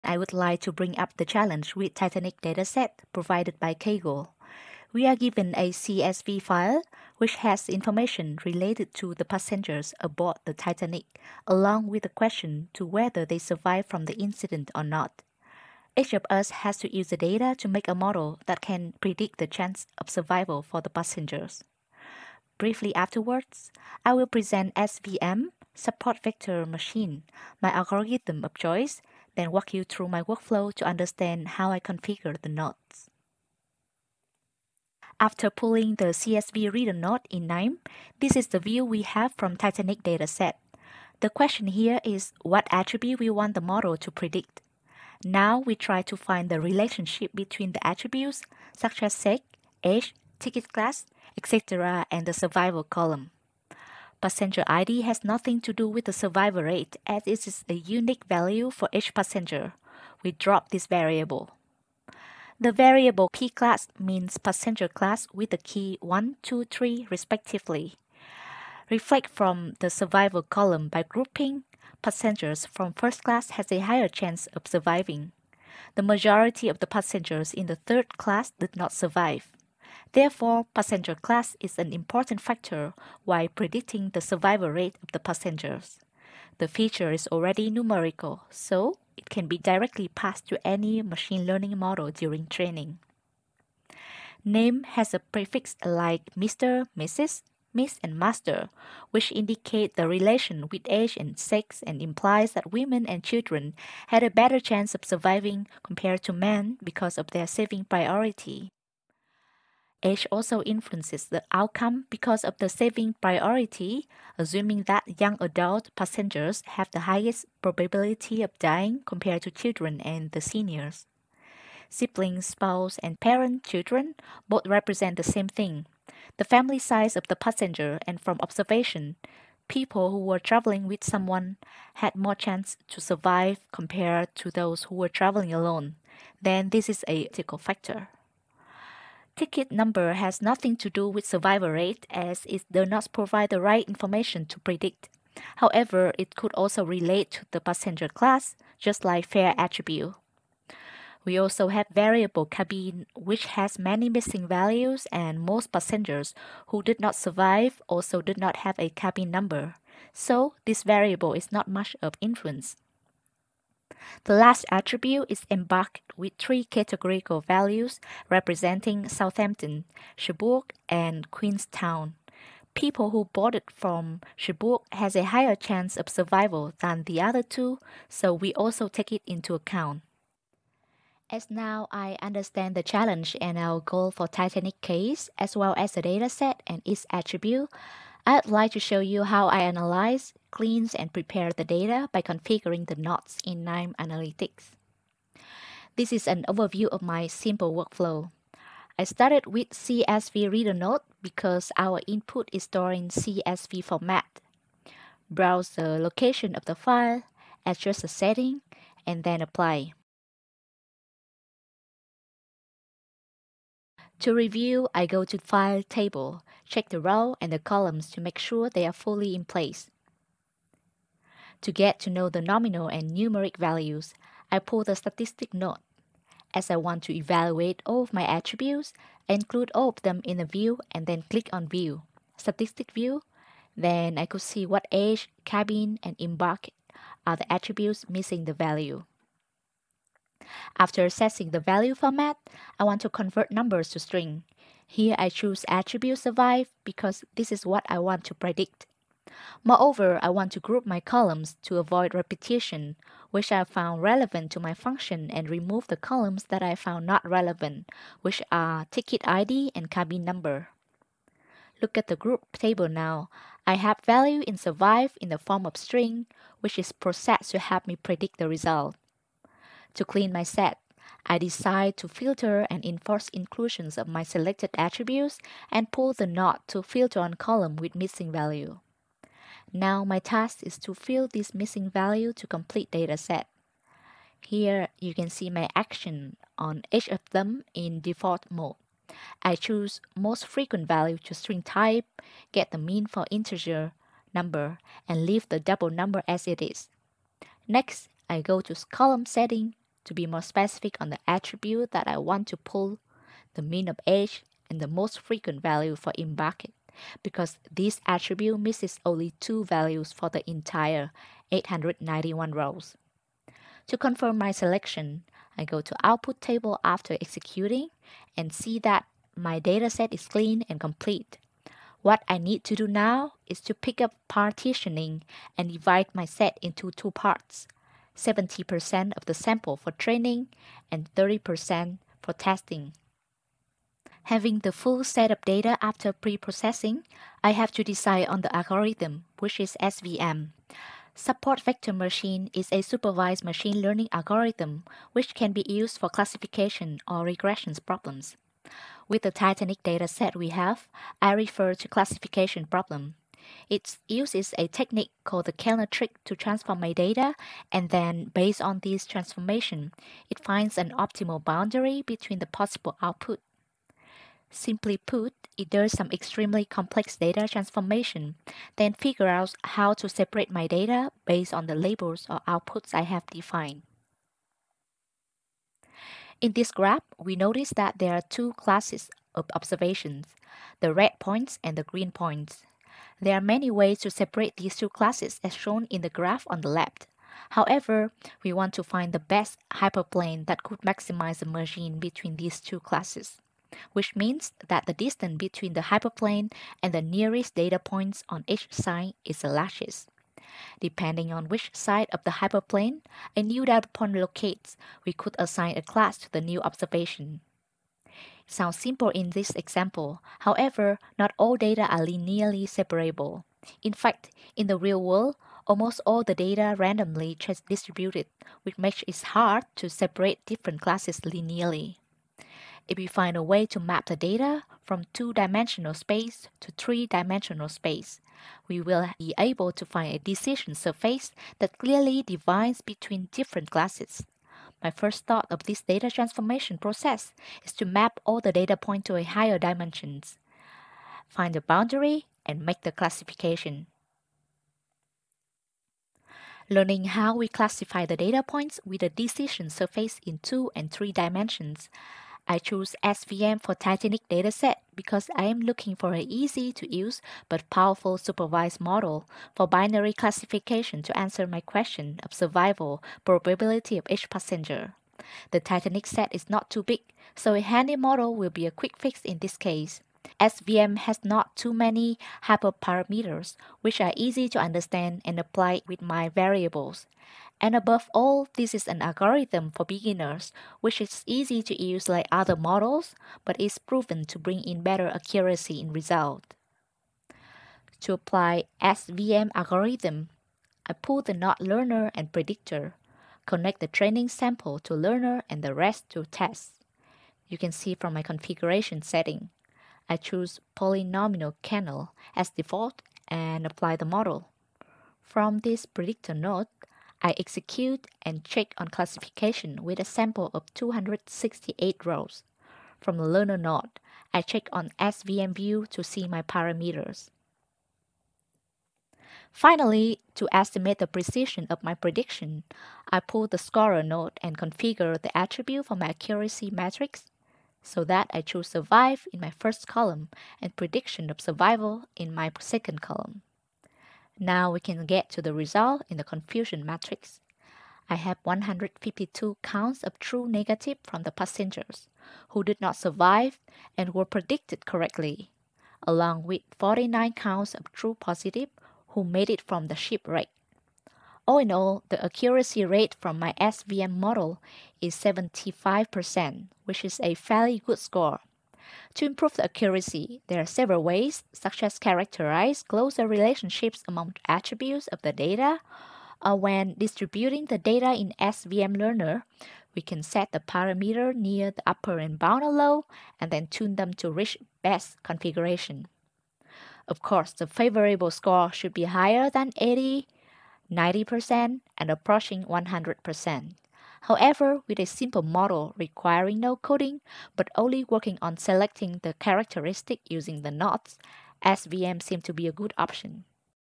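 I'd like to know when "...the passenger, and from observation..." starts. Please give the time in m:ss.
2:07.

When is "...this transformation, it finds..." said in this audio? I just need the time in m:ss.
5:58.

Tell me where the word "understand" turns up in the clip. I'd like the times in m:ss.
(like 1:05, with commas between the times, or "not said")
0:30, 3:02, 7:54.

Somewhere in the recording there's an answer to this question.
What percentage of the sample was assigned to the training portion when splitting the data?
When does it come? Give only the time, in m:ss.
5:28.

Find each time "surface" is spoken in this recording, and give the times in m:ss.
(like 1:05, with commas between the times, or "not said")
7:10, 7:29.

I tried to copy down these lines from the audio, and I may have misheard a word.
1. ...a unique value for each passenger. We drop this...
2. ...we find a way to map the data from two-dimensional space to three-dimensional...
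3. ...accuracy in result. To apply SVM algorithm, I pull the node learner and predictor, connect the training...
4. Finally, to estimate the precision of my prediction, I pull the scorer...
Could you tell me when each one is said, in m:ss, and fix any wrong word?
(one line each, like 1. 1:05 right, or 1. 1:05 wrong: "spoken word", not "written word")
1. 0:57 right
2. 7:02 right
3. 8:05 right
4. 8:39 right.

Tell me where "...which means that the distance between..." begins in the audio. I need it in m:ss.
6:33.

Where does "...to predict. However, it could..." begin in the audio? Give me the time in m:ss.
2:24.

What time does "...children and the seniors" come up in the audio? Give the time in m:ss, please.
1:59.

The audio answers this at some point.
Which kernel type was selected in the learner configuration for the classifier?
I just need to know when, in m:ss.
8:20.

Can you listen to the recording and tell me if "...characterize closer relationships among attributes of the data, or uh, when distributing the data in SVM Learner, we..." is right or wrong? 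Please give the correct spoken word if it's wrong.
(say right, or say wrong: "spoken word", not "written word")
right.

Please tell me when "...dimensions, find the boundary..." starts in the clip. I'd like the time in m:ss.
7:19.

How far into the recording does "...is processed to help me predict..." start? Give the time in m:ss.
4:26.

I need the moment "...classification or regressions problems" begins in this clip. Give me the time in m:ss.
5:46.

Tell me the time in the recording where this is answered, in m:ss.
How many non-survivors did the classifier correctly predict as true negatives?
8:58.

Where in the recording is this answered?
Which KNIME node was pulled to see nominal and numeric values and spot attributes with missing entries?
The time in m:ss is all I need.
3:44.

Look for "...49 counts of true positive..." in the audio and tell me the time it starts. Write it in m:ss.
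9:06.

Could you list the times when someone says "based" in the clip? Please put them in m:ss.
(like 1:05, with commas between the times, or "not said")
5:58, 6:11.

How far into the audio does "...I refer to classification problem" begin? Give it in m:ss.
5:51.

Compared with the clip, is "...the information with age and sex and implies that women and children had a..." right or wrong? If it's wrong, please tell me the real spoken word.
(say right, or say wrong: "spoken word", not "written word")
wrong: "relation", not "information".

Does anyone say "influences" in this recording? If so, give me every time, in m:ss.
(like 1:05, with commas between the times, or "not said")
1:50, 2:42.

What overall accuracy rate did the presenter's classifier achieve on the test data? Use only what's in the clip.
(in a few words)
75%.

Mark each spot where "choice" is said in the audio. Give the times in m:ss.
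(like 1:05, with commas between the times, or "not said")
0:28.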